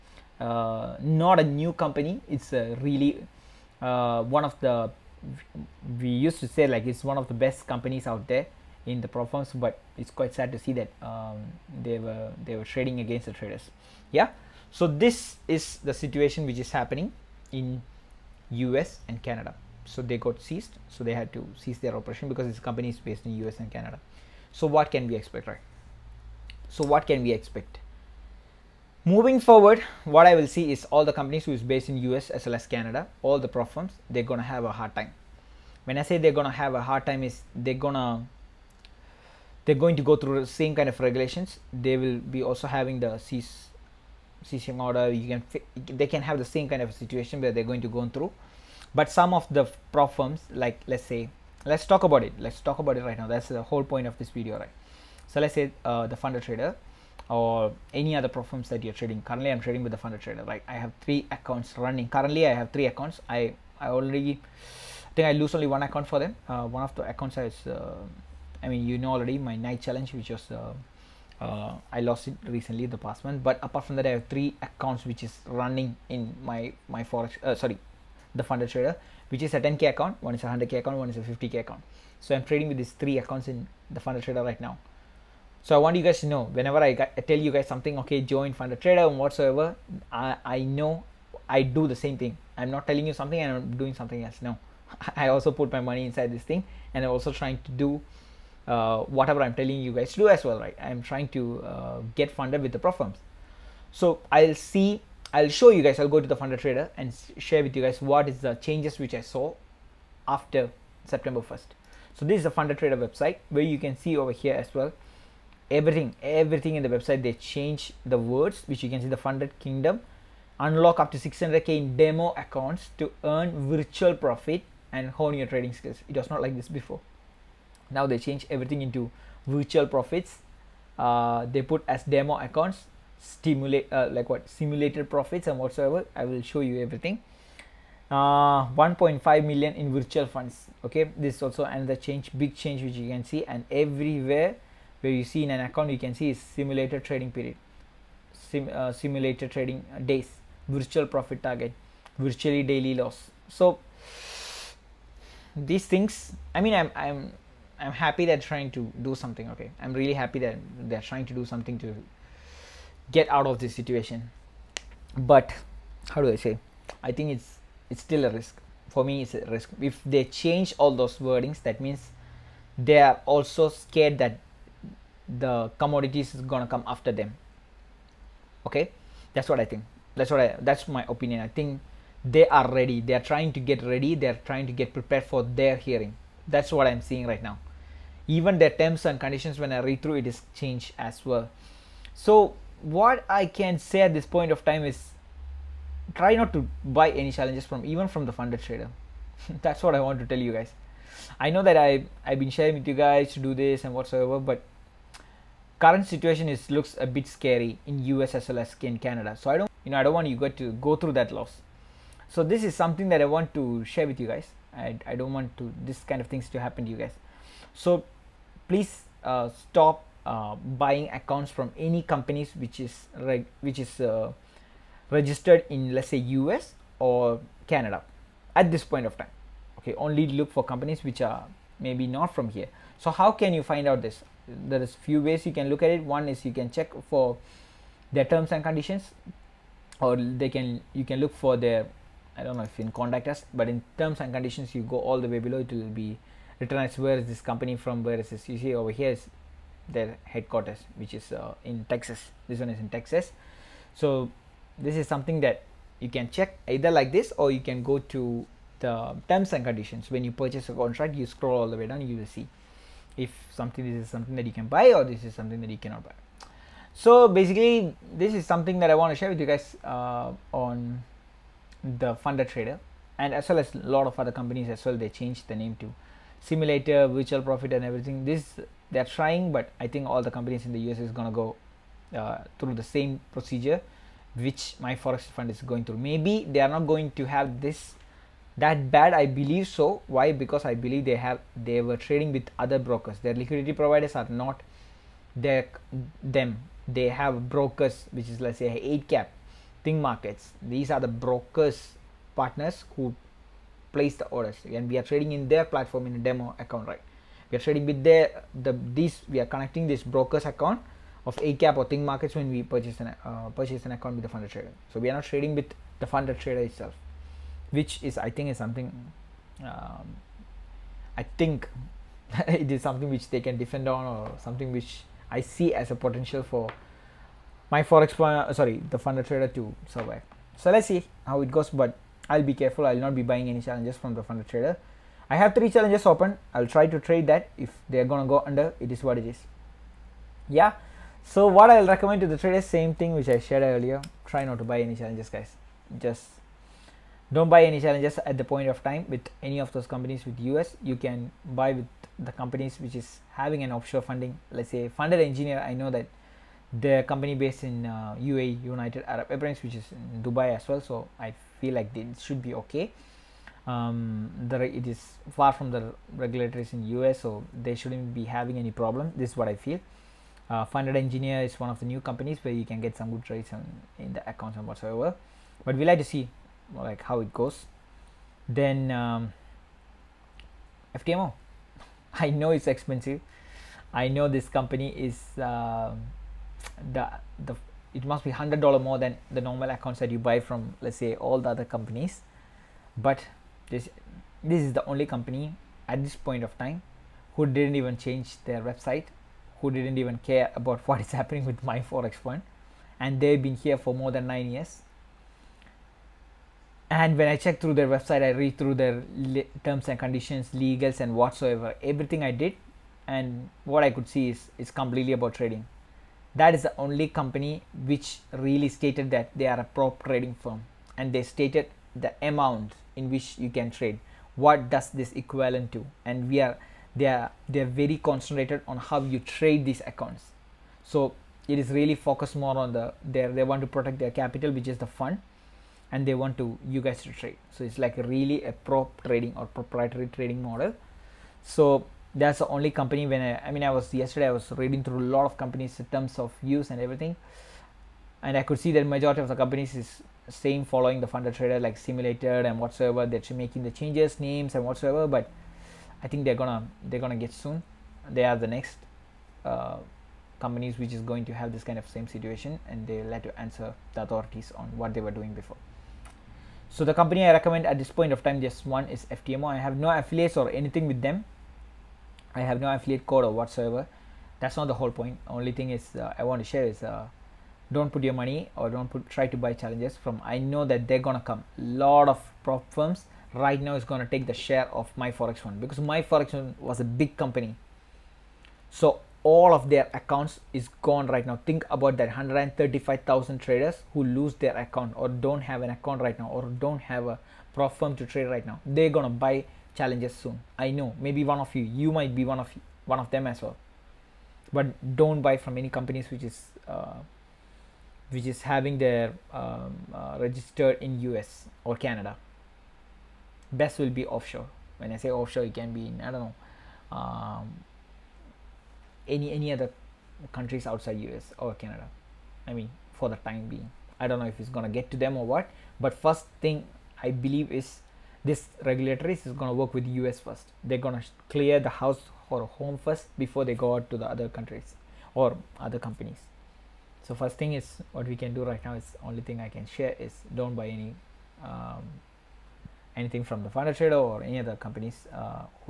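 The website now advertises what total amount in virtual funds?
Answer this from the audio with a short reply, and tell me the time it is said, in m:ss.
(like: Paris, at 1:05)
1.5 million, at 2:18.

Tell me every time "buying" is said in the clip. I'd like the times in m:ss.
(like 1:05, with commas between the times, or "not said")
3:40, 5:33.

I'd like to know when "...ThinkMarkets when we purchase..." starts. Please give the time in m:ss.
5:11.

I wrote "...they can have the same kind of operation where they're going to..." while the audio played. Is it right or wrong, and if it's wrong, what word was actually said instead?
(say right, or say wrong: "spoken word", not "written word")
wrong: "situation", not "operation".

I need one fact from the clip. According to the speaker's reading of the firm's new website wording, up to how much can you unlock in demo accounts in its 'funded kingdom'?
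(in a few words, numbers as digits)
600k.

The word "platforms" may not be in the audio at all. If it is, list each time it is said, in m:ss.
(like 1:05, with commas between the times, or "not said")
0:58, 5:05.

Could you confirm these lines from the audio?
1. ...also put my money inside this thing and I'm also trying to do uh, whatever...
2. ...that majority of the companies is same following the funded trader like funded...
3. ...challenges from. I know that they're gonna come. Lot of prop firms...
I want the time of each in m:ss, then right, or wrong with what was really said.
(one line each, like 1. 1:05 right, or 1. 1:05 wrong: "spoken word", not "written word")
1. 1:35 right
2. 7:28 wrong: "simulated", not "funded"
3. 7:59 right.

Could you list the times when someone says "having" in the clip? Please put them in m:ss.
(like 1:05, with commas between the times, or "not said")
0:42, 5:53, 6:08, 8:28.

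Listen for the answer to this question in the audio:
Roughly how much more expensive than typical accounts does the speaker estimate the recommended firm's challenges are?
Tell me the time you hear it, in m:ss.
6:28.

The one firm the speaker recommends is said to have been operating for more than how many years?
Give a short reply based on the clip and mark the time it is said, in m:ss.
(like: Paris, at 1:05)
9, at 6:44.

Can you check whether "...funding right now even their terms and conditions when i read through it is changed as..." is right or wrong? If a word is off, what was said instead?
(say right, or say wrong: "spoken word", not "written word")
wrong: "seeing", not "funding".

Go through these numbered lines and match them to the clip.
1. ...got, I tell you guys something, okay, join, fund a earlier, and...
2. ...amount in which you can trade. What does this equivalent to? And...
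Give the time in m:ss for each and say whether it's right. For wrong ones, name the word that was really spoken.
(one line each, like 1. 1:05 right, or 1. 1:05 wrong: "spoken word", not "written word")
1. 1:26 wrong: "trader", not "earlier"
2. 7:02 right.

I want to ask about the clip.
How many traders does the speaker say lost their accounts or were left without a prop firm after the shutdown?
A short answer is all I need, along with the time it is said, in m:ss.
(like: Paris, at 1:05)
135000, at 8:12.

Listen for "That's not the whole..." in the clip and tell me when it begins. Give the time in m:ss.
7:54.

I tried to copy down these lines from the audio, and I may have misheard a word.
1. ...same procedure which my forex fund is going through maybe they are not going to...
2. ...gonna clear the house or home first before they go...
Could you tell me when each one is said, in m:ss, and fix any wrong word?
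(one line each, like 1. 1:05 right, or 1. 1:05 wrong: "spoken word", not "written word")
1. 4:42 right
2. 8:50 right.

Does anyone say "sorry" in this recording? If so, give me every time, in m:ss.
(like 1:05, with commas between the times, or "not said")
1:17, 5:28.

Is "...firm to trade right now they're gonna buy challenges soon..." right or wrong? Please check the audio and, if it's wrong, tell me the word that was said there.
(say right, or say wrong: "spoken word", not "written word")
right.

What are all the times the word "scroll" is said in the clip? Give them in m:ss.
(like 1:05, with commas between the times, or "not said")
4:21.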